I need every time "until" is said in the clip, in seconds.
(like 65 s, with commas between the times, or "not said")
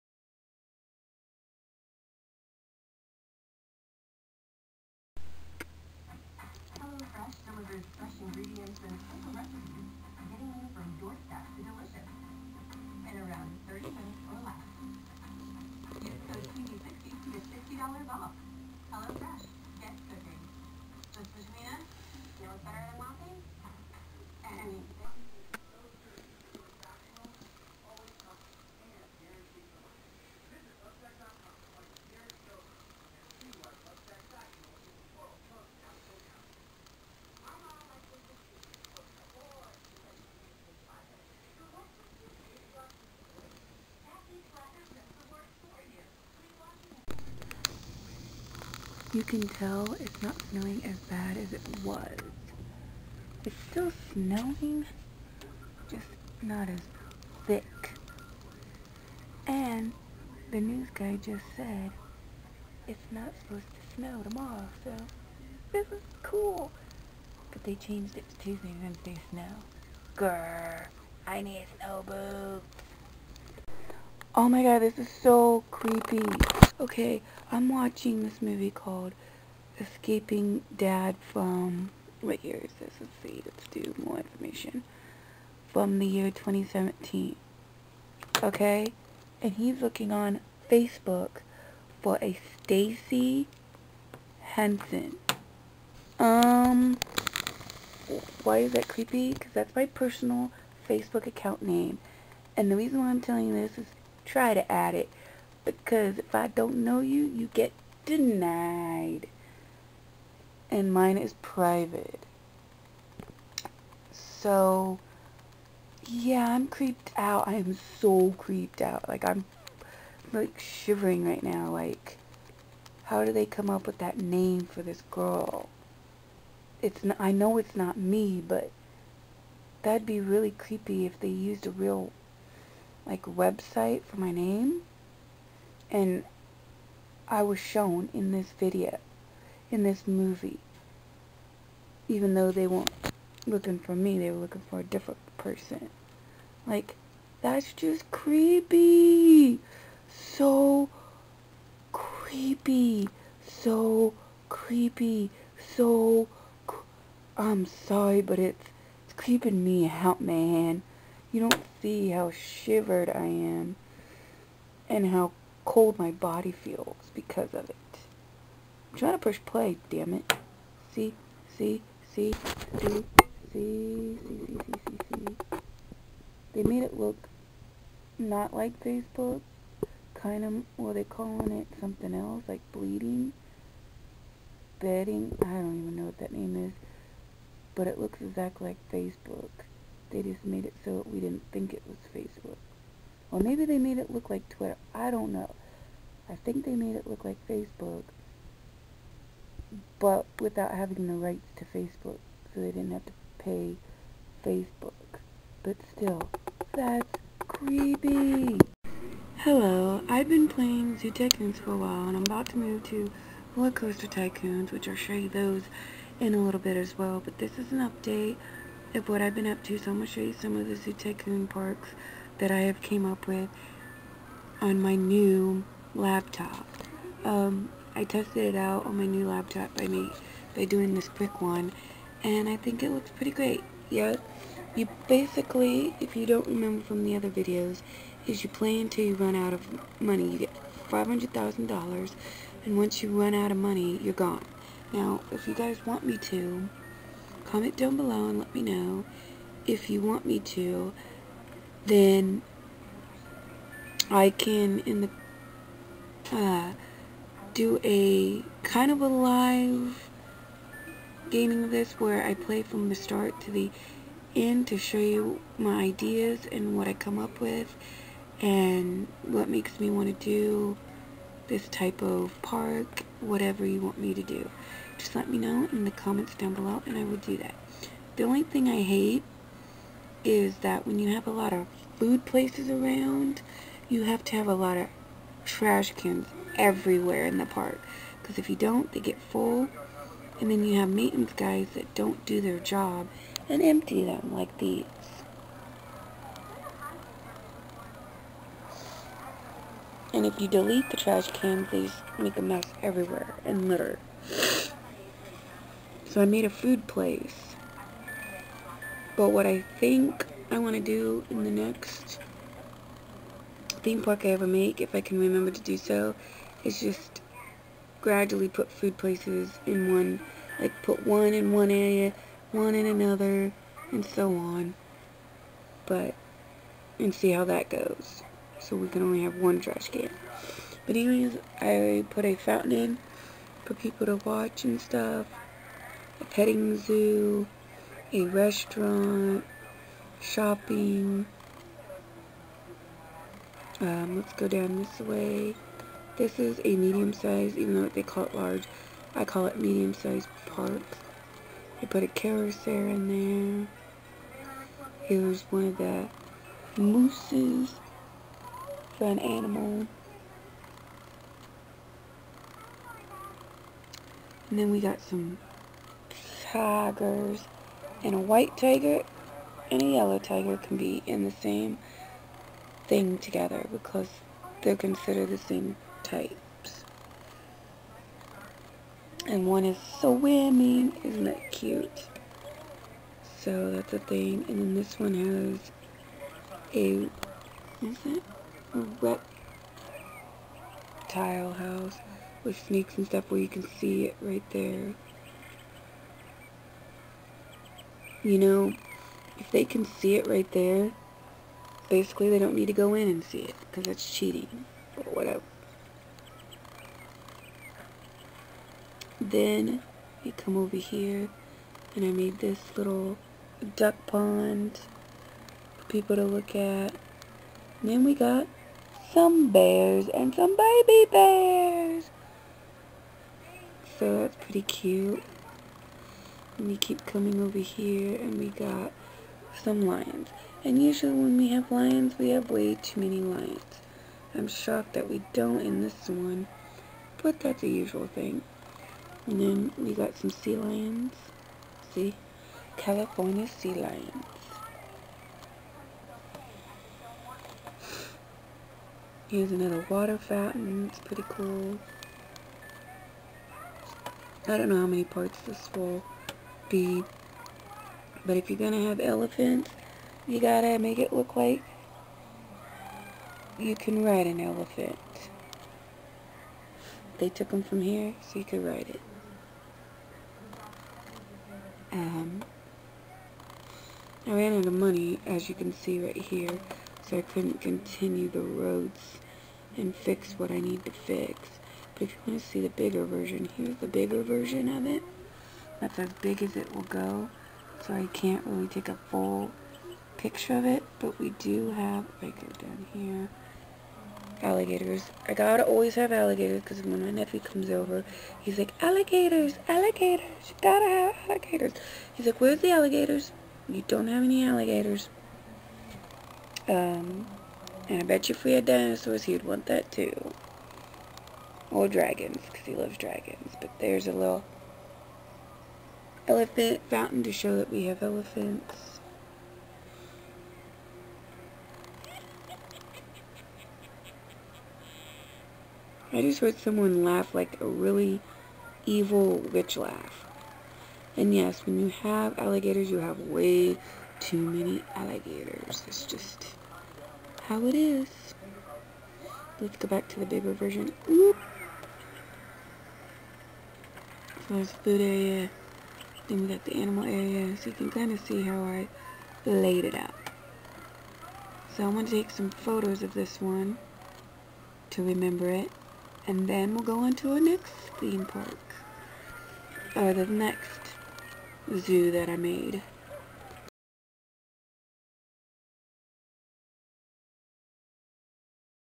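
238 s.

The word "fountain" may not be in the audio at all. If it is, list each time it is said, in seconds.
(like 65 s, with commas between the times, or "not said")
332 s, 450 s, 516 s.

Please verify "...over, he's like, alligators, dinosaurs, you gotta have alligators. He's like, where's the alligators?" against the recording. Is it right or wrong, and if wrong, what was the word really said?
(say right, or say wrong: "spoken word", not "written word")
wrong: "alligators", not "dinosaurs".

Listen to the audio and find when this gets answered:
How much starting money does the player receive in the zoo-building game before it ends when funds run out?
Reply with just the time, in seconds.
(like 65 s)
240 s.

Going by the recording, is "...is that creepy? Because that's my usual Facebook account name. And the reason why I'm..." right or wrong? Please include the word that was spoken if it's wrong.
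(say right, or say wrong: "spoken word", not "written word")
wrong: "personal", not "usual".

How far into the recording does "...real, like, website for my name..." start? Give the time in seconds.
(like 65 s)
131 s.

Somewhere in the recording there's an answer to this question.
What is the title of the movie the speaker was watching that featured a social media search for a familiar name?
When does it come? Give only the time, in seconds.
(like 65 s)
79 s.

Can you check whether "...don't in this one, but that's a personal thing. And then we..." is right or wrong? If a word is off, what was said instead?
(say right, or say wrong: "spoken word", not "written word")
wrong: "usual", not "personal".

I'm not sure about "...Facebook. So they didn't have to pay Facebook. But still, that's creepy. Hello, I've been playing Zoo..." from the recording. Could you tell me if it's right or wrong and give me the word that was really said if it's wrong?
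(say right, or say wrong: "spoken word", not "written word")
right.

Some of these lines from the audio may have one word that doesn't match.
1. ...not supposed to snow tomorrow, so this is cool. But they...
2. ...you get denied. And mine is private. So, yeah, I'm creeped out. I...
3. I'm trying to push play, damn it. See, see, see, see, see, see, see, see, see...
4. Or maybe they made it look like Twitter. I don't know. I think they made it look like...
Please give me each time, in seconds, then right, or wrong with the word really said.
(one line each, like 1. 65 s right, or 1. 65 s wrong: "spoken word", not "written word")
1. 63 s right
2. 107 s right
3. 168 s right
4. 193 s right.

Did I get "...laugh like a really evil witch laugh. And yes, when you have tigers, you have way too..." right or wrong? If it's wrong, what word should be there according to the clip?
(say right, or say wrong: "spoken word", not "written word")
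wrong: "alligators", not "tigers".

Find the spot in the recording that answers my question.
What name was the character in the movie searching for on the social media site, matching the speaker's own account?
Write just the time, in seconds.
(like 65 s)
92 s.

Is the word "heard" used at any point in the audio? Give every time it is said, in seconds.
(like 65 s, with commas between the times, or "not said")
526 s.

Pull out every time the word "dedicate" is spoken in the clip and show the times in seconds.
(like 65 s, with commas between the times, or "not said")
not said.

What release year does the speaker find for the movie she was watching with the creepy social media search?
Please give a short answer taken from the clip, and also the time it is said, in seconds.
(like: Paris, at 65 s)
2017, at 86 s.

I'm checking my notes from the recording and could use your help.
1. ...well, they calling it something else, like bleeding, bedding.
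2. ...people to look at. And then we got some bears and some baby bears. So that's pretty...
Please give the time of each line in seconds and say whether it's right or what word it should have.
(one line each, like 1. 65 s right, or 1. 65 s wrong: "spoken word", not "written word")
1. 180 s right
2. 415 s right.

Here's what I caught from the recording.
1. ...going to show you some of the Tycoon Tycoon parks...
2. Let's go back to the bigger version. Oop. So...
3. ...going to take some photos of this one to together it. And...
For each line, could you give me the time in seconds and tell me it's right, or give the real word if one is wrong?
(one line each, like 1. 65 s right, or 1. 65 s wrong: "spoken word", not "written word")
1. 219 s wrong: "Zoo", not "Tycoon"
2. 539 s right
3. 551 s wrong: "remember", not "together".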